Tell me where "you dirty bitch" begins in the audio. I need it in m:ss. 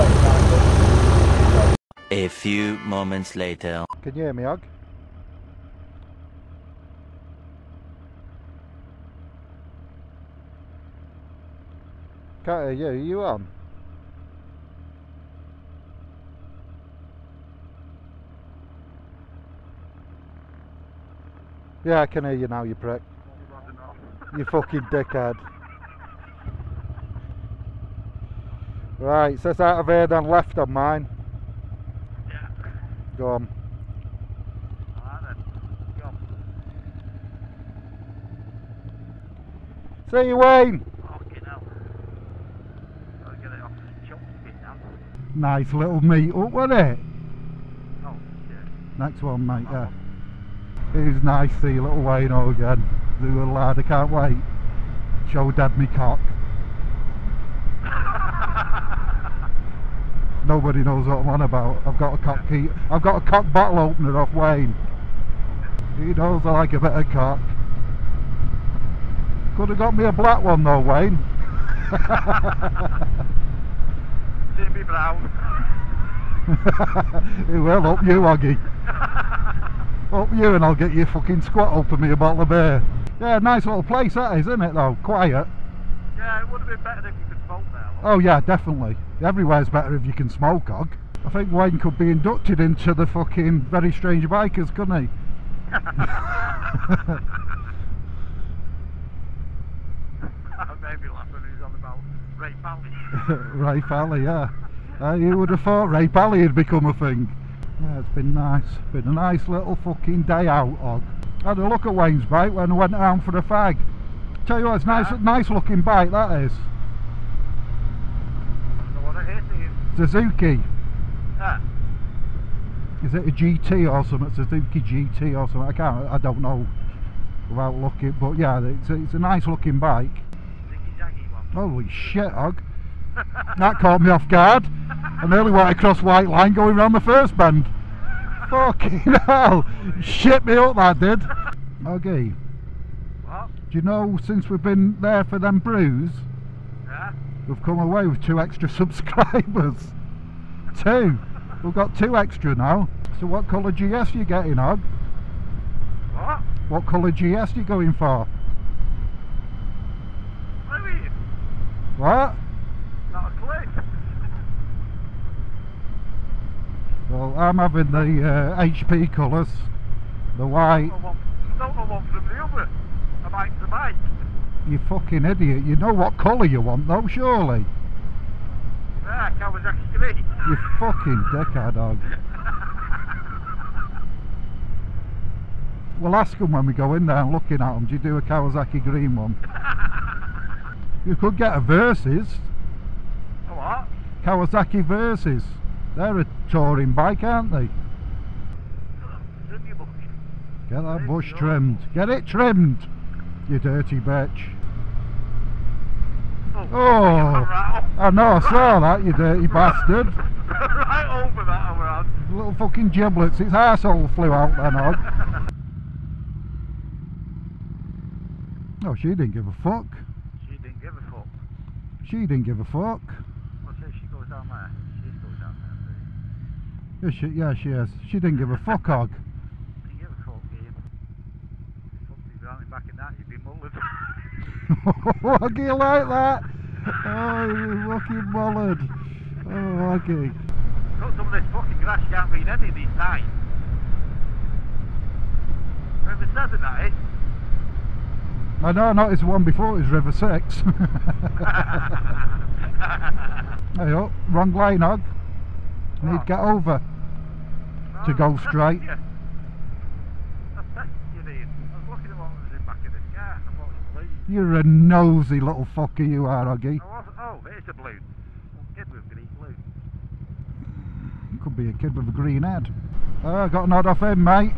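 3:23.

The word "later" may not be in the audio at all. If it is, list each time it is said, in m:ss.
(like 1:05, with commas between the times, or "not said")
0:03.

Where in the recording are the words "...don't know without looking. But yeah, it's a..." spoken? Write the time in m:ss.
2:06.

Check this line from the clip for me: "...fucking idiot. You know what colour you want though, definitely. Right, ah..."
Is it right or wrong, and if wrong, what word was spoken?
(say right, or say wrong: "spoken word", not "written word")
wrong: "surely", not "definitely".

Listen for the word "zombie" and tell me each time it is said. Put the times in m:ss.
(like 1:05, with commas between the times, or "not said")
not said.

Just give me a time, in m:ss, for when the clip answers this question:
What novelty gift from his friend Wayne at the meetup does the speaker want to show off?
1:03.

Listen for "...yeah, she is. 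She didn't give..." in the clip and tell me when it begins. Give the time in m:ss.
3:47.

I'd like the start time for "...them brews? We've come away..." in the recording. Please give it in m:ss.
2:25.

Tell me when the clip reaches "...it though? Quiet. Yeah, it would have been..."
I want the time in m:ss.
1:24.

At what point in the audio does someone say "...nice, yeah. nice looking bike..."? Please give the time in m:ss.
1:54.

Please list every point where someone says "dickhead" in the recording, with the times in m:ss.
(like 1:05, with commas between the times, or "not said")
0:24, 3:01.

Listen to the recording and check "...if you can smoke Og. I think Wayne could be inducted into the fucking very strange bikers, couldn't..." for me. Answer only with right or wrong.
right.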